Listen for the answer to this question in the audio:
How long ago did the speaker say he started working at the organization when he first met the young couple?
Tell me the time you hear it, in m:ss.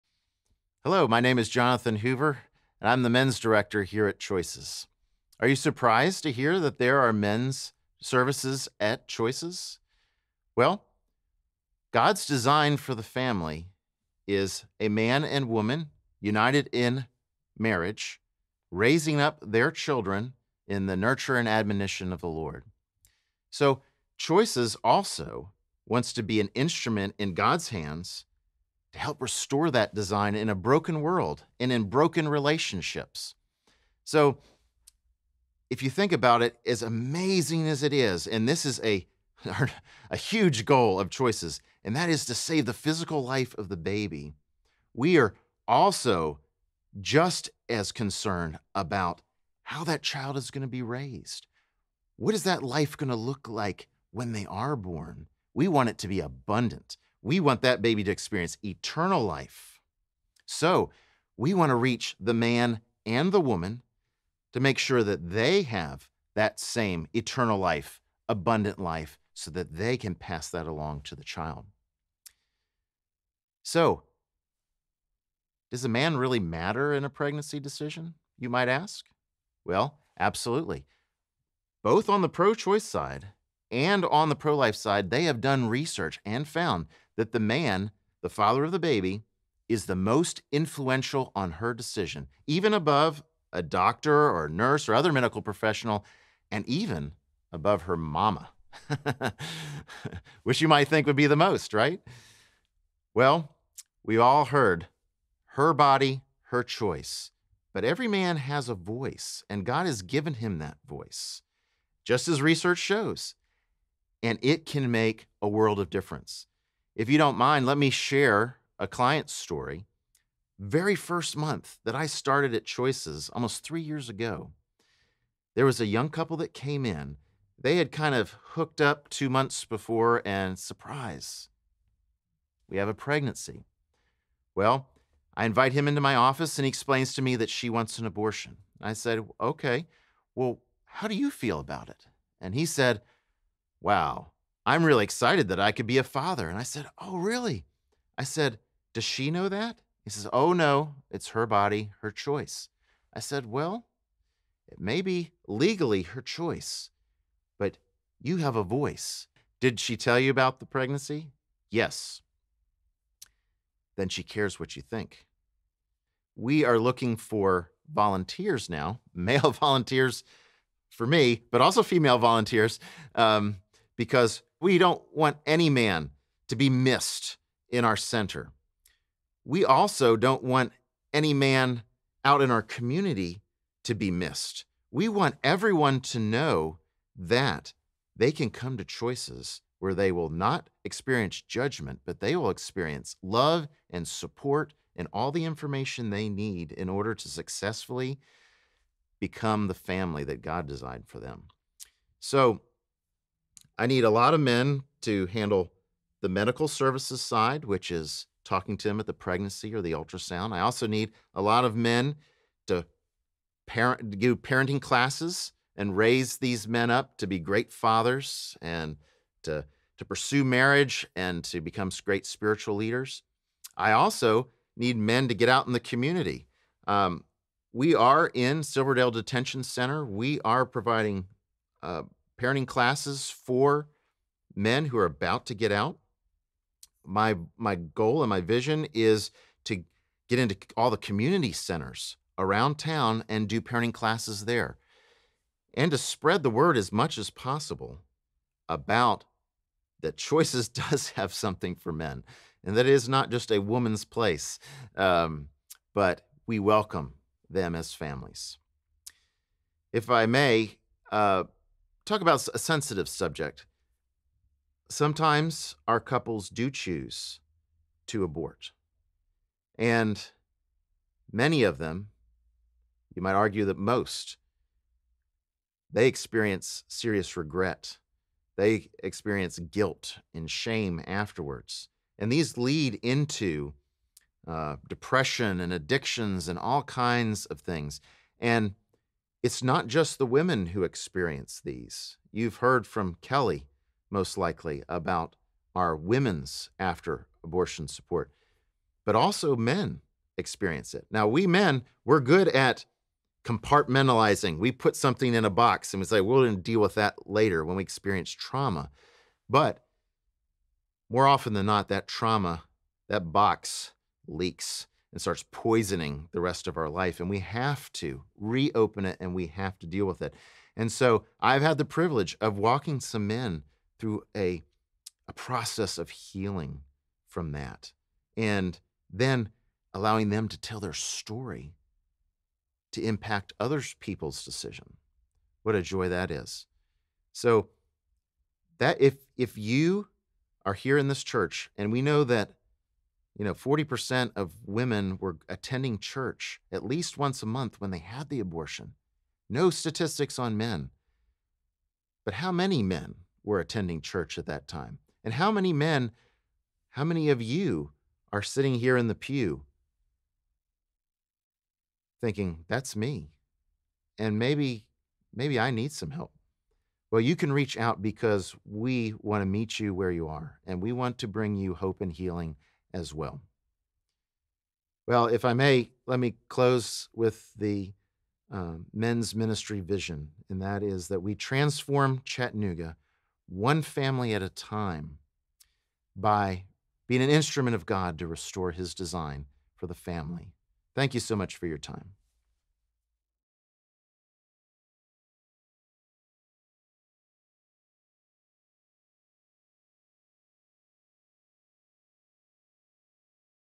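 2:03.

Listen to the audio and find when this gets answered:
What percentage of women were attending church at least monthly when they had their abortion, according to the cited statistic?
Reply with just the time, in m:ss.
5:43.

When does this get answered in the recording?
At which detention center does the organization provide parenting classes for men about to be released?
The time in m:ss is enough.
3:48.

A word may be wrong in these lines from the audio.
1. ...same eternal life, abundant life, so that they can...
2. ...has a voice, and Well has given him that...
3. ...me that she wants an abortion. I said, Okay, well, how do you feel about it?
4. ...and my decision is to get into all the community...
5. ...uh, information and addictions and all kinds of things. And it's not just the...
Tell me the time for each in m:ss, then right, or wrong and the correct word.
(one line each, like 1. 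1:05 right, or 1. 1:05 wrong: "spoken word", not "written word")
1. 1:06 right
2. 1:48 wrong: "God", not "Well"
3. 2:17 right
4. 3:58 wrong: "vision", not "decision"
5. 4:44 wrong: "depression", not "information".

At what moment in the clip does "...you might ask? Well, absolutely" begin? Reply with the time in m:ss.
1:18.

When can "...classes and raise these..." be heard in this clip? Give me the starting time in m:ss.
3:34.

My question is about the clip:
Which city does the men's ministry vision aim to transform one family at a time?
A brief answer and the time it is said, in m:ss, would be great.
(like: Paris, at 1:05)
Chattanooga, at 6:22.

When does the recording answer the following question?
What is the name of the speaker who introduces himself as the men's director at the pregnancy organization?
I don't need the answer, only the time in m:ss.
0:01.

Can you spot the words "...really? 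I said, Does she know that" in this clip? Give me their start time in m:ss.
2:27.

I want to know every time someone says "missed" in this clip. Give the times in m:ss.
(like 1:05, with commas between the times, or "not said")
2:56, 3:04.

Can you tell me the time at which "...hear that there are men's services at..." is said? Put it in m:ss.
0:06.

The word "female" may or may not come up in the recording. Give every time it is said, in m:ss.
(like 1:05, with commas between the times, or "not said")
2:51.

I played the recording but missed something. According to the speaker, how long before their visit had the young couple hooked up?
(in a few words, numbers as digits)
2 months.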